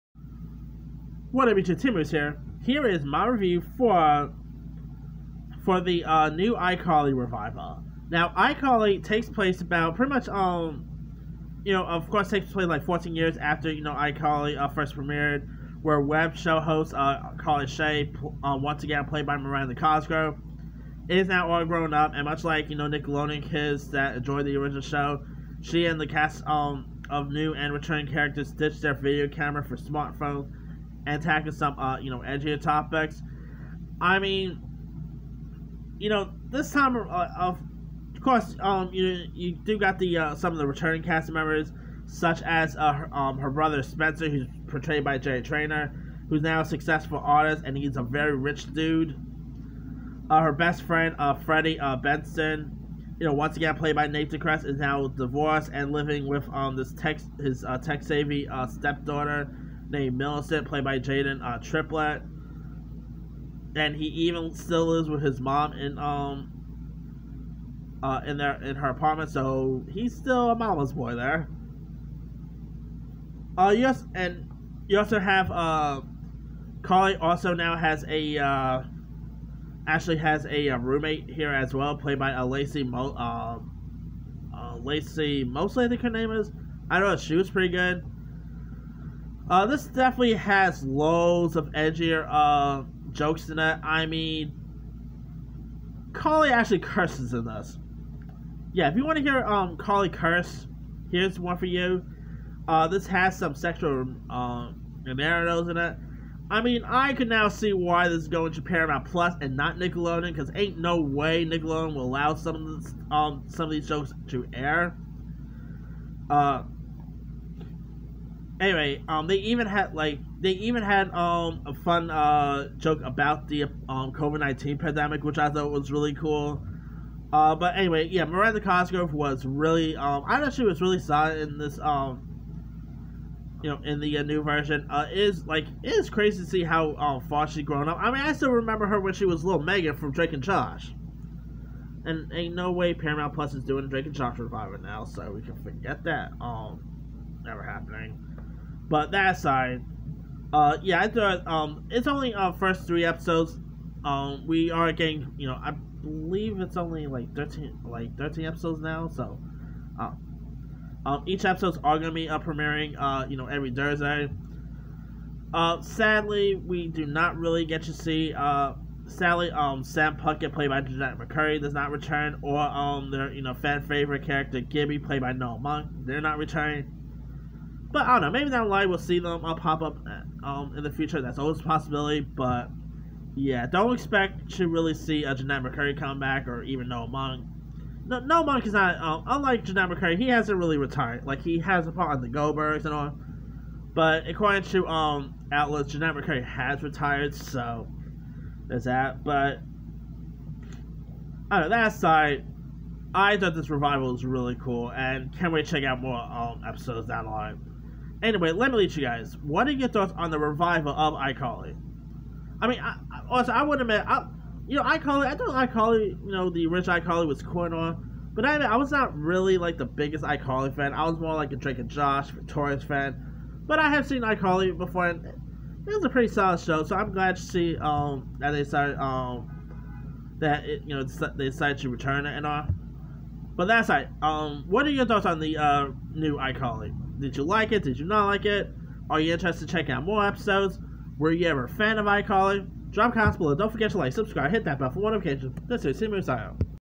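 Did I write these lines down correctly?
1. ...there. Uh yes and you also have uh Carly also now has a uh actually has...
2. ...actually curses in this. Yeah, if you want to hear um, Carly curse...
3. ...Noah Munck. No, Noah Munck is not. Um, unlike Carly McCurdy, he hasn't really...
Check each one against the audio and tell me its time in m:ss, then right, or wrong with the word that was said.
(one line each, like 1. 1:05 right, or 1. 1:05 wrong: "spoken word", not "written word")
1. 1:11 right
2. 1:36 right
3. 3:06 wrong: "Jennette", not "Carly".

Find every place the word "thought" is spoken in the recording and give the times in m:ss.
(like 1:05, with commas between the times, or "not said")
2:05, 2:10, 2:31, 3:23, 3:29, 3:35, 3:55.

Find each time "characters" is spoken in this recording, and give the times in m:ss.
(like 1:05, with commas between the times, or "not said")
0:28, 2:54.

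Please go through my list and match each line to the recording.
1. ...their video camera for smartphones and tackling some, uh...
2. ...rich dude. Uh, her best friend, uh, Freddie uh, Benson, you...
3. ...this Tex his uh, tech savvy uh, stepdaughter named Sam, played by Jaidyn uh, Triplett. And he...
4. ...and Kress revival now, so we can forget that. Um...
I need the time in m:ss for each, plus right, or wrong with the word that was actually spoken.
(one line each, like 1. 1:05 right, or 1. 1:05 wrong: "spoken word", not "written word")
1. 0:28 right
2. 0:48 right
3. 0:56 wrong: "Millicent", not "Sam"
4. 2:24 wrong: "Josh", not "Kress".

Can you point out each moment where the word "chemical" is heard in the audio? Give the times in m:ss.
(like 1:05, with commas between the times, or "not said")
not said.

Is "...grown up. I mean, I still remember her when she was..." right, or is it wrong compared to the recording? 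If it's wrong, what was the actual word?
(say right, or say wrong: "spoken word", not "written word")
right.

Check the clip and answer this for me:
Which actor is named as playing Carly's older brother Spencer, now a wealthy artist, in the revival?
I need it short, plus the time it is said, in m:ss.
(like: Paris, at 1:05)
Jay Trainor, at 0:45.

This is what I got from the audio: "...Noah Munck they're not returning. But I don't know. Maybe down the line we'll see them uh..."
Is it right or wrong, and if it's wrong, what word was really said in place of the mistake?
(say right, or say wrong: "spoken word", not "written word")
right.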